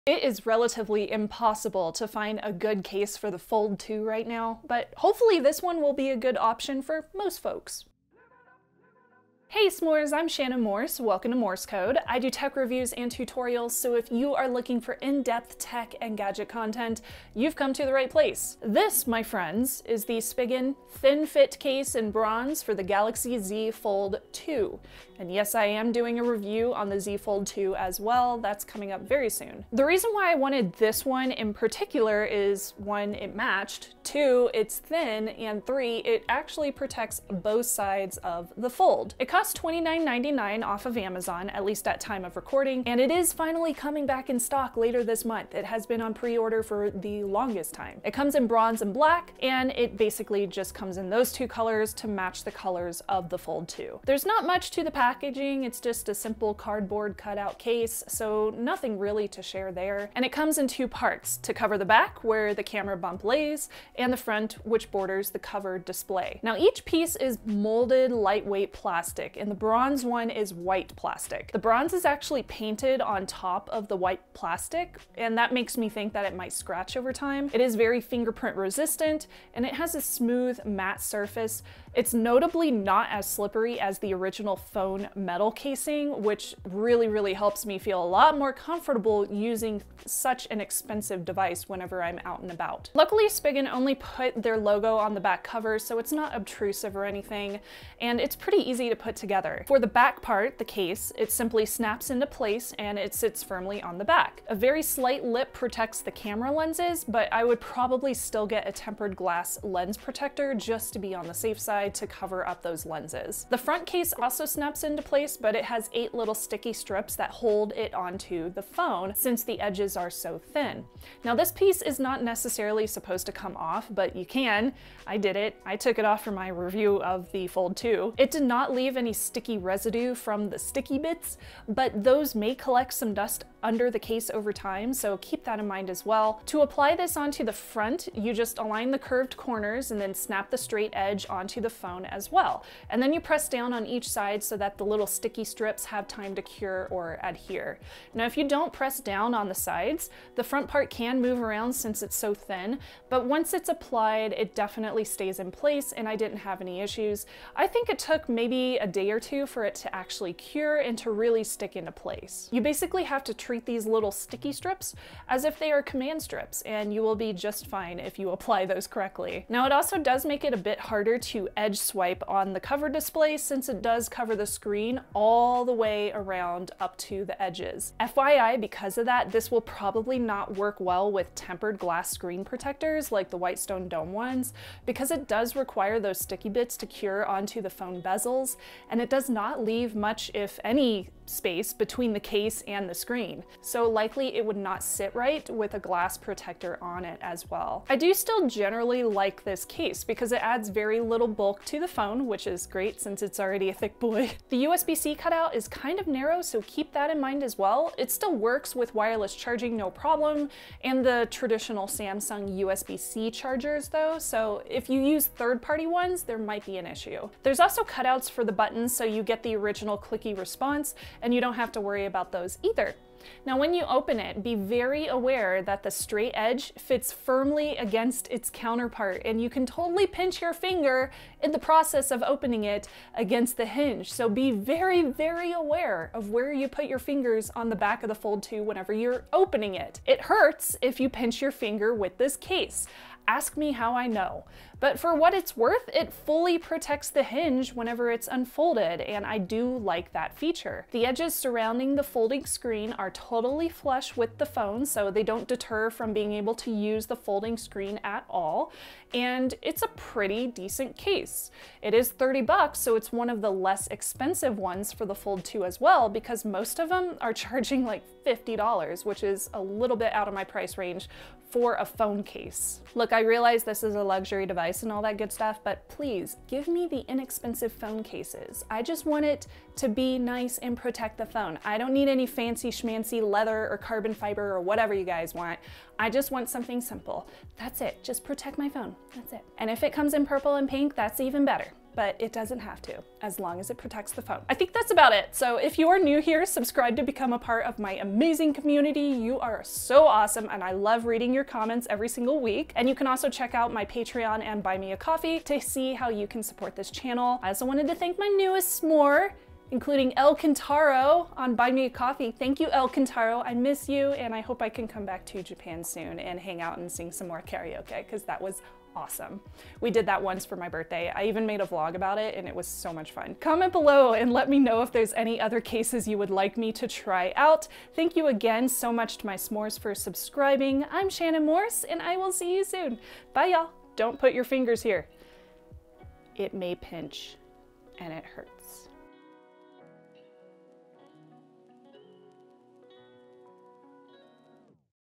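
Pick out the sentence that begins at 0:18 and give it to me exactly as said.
This, my friends, is the Spigen Thin Fit case in bronze for the Galaxy Z Fold 2.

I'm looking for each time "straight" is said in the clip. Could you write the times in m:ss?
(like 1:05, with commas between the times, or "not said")
2:20, 3:45.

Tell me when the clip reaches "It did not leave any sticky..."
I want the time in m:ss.
2:08.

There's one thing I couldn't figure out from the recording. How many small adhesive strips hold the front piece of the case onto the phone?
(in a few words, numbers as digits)
8.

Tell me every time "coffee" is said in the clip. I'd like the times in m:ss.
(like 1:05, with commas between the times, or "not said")
5:04, 5:11.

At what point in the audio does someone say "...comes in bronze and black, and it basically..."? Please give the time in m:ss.
0:48.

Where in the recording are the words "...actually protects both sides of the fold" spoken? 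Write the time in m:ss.
0:36.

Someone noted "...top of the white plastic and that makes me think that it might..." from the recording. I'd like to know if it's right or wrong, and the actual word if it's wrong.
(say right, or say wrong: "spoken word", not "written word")
right.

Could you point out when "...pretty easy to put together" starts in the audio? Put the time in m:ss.
1:38.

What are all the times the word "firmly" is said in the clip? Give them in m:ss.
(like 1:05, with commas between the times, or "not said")
1:43, 3:47.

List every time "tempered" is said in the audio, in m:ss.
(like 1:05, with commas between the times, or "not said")
1:48, 3:01.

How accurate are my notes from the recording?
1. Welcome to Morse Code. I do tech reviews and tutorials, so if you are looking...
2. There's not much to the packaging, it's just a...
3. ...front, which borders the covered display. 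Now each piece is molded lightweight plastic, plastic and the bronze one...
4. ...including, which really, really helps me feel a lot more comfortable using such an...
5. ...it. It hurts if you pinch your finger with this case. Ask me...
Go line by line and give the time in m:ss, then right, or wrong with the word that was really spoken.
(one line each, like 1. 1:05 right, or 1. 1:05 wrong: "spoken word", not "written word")
1. 0:11 right
2. 0:54 right
3. 1:04 right
4. 1:25 wrong: "casing", not "including"
5. 3:59 right.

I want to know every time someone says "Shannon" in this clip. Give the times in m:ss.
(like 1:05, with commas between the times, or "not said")
0:10, 5:31.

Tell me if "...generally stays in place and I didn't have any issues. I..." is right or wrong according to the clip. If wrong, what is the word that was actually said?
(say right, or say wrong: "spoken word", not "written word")
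wrong: "definitely", not "generally".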